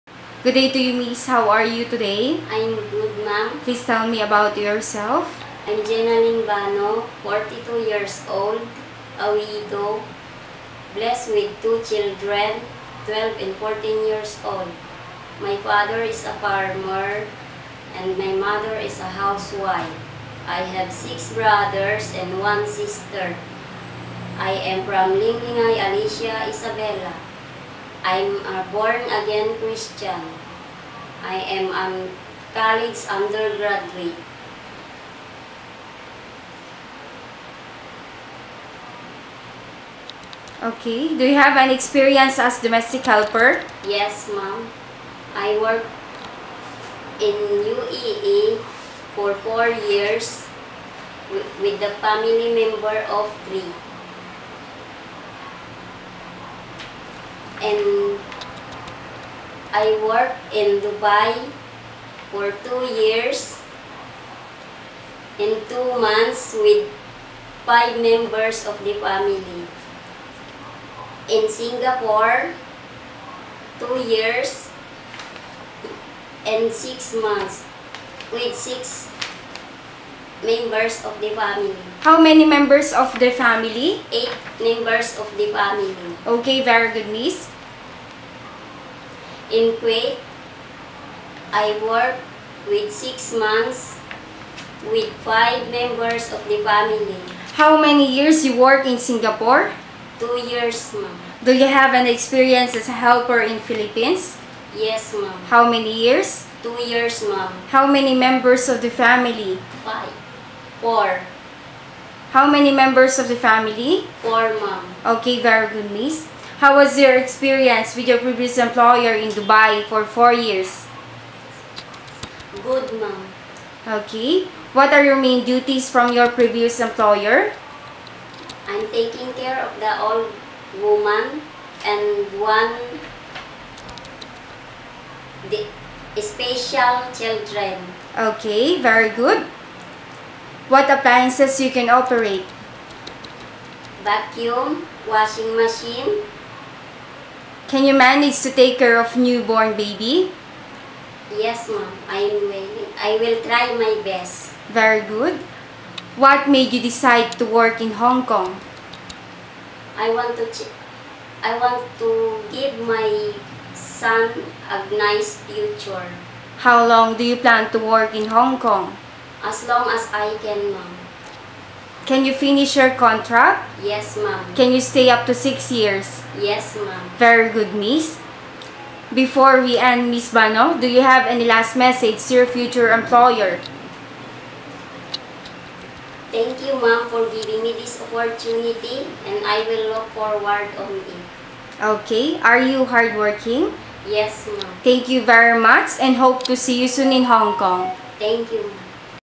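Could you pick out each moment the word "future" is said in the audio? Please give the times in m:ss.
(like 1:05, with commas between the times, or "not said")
2:45, 3:02.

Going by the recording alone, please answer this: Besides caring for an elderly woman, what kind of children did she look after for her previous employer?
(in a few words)
special children.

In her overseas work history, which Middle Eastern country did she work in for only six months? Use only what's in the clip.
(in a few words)
Kuwait.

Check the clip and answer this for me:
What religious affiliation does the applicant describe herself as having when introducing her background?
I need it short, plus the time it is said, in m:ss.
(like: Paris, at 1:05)
Born-again Christian, at 0:28.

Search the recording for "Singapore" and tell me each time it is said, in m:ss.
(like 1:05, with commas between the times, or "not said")
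1:11, 1:38.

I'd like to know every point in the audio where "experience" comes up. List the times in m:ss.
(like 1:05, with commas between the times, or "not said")
0:41, 1:42, 1:57.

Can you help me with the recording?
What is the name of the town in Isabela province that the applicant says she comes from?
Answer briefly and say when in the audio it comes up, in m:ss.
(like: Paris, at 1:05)
Alicia, at 0:25.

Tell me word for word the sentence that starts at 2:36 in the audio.
What made you decide to work in Hong Kong?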